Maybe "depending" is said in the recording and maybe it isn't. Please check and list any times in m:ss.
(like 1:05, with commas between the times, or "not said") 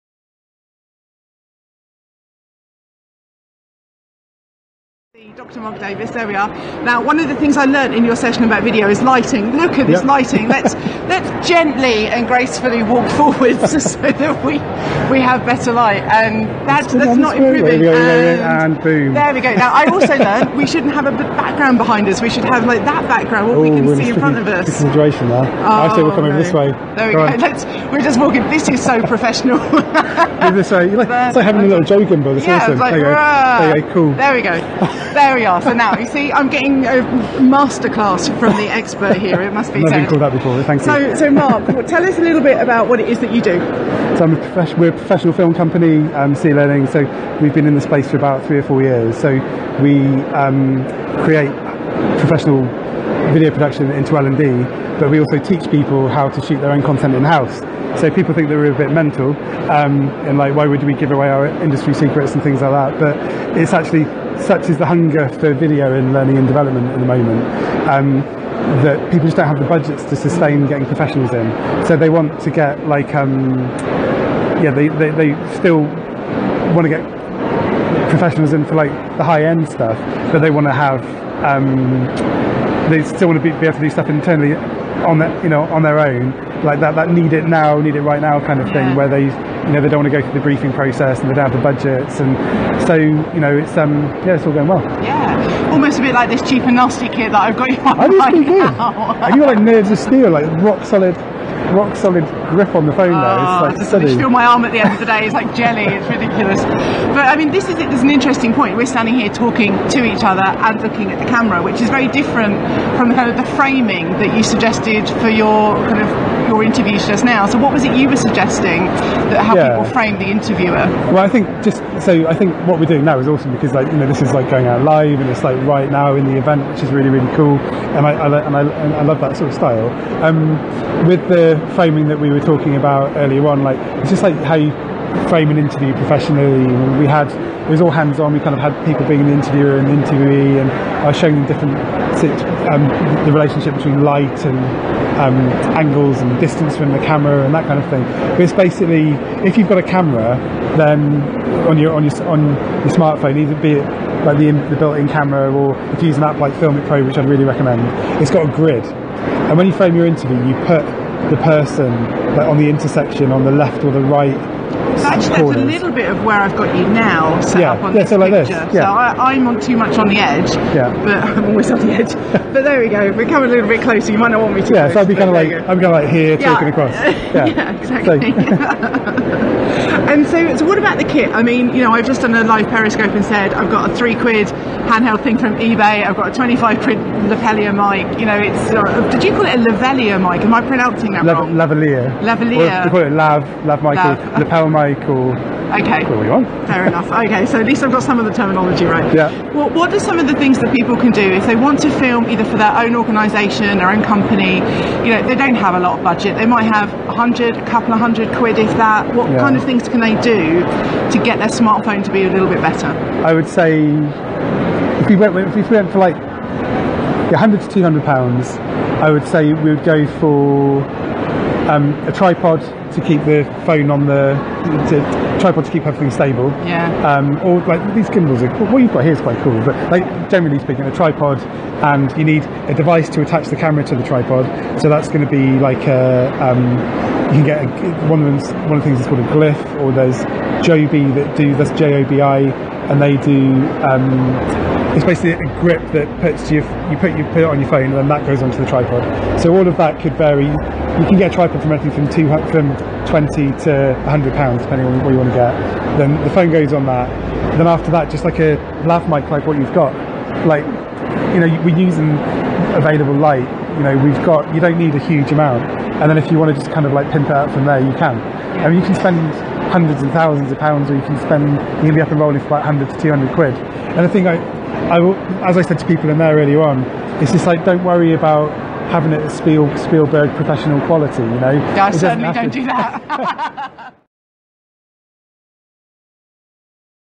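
4:14.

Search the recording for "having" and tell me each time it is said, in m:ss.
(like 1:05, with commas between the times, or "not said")
0:31, 4:38.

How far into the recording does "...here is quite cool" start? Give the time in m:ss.
3:49.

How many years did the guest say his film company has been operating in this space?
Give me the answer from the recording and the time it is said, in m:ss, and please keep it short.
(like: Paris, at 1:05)
3 or 4 years, at 0:48.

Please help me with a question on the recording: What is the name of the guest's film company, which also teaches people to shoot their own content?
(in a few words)
SeeLearning.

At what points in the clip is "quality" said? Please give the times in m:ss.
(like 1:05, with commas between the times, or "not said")
4:40.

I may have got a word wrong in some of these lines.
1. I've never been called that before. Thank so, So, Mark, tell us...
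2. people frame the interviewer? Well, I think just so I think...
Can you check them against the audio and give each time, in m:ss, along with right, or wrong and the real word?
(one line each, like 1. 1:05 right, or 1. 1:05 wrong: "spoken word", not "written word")
1. 0:39 right
2. 1:59 right.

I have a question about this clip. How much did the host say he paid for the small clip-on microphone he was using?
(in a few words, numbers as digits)
25 quid.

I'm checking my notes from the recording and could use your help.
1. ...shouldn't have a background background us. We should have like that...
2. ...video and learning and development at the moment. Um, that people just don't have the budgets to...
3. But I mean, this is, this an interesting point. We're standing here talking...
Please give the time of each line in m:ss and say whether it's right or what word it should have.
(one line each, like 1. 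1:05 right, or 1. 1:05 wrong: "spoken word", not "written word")
1. 0:20 wrong: "behind", not "background"
2. 1:05 right
3. 1:46 right.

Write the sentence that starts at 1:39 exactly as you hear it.
you like nerves of steel, like rock solid rock solid grip on the phone though.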